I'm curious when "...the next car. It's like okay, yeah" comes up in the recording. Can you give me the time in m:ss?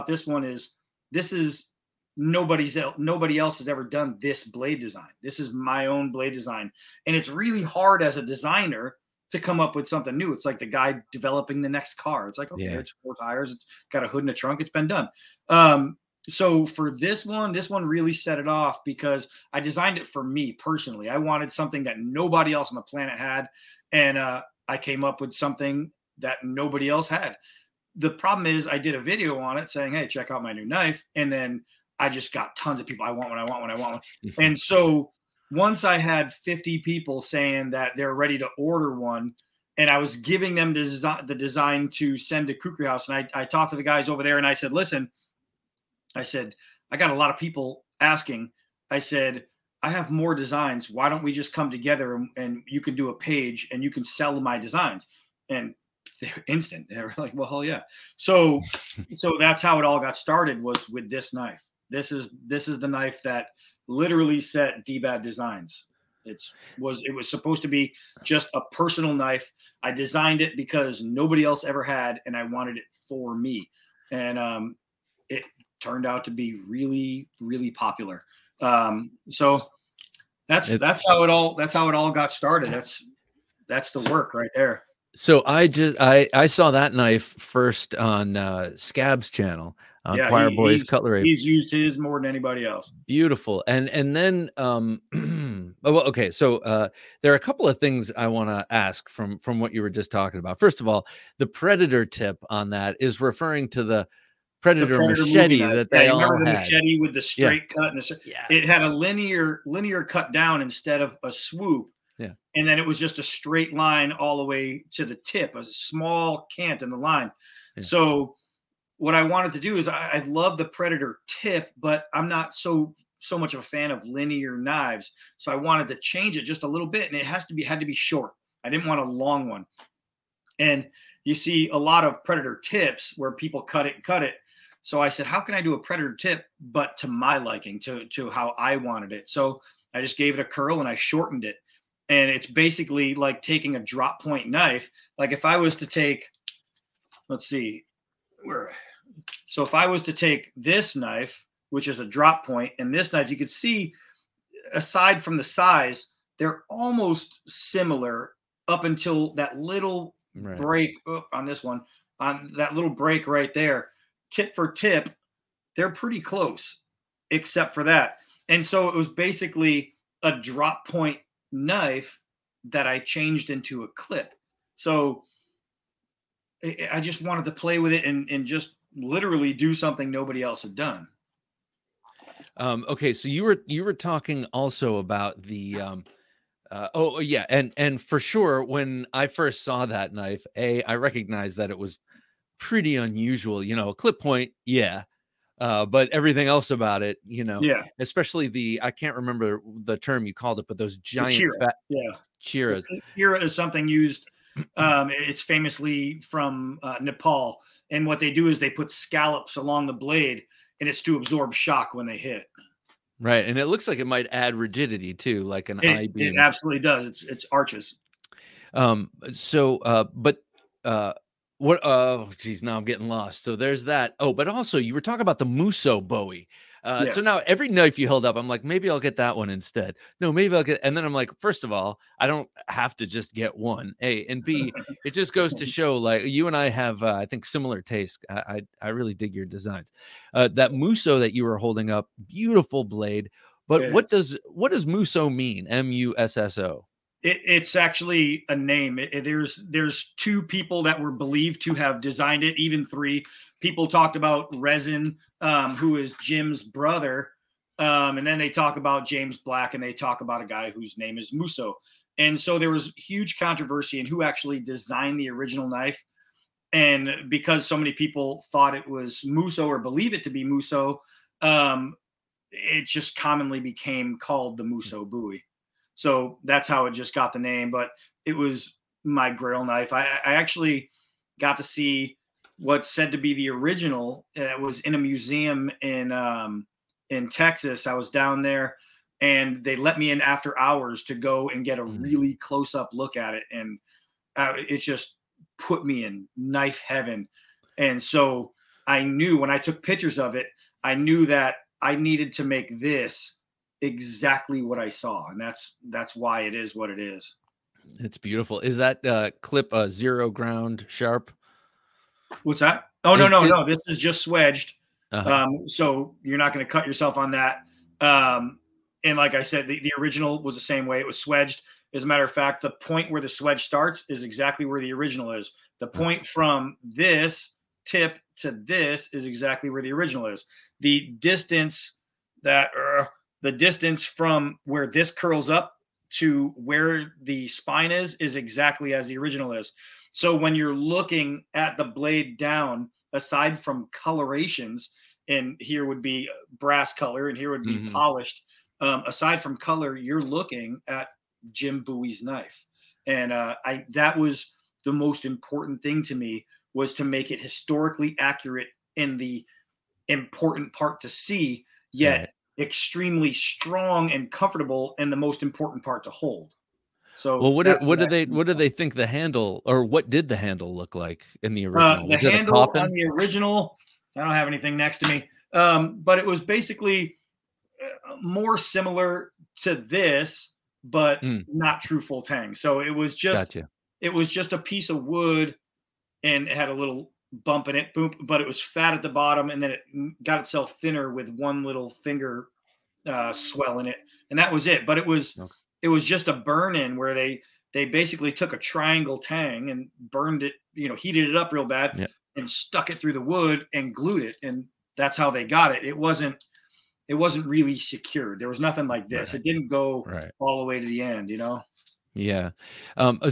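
0:11.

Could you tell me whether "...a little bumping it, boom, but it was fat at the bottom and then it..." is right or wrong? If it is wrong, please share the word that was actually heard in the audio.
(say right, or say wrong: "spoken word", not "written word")
right.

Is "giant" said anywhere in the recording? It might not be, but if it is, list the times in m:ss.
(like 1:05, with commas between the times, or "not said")
3:20.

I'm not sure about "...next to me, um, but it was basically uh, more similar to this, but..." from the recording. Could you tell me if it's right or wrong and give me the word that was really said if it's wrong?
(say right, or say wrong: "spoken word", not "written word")
right.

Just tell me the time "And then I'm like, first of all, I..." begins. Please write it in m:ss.
3:50.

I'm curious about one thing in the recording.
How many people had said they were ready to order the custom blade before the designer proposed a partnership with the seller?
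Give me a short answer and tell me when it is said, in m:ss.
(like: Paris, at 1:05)
50, at 0:36.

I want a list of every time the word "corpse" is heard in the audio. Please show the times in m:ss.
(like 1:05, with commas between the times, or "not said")
not said.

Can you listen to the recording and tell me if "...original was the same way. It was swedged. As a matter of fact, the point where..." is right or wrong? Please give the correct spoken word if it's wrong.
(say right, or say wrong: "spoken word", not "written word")
right.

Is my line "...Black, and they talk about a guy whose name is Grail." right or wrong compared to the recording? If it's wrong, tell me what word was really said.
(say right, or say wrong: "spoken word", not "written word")
wrong: "Musso", not "Grail".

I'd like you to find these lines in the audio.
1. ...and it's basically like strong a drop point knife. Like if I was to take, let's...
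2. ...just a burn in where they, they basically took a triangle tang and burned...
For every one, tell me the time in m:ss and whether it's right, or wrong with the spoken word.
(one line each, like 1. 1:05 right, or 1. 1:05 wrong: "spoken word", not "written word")
1. 2:22 wrong: "taking", not "strong"
2. 6:36 right.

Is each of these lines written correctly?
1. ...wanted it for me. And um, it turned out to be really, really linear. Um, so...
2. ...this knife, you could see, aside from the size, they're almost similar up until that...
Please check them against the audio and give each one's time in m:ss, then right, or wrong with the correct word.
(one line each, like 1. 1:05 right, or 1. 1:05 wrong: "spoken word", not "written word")
1. 1:12 wrong: "popular", not "linear"
2. 2:32 right.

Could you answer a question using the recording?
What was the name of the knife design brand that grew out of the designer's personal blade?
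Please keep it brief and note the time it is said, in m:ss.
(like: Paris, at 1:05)
D-Bad Designs, at 1:04.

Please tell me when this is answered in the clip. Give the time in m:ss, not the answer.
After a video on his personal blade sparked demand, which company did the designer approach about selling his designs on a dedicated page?
0:42.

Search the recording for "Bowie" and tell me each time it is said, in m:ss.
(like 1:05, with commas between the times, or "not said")
3:46, 4:35, 5:51.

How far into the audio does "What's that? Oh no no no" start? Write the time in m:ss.
5:12.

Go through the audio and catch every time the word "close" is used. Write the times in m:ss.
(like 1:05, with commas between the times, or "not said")
2:46, 4:52.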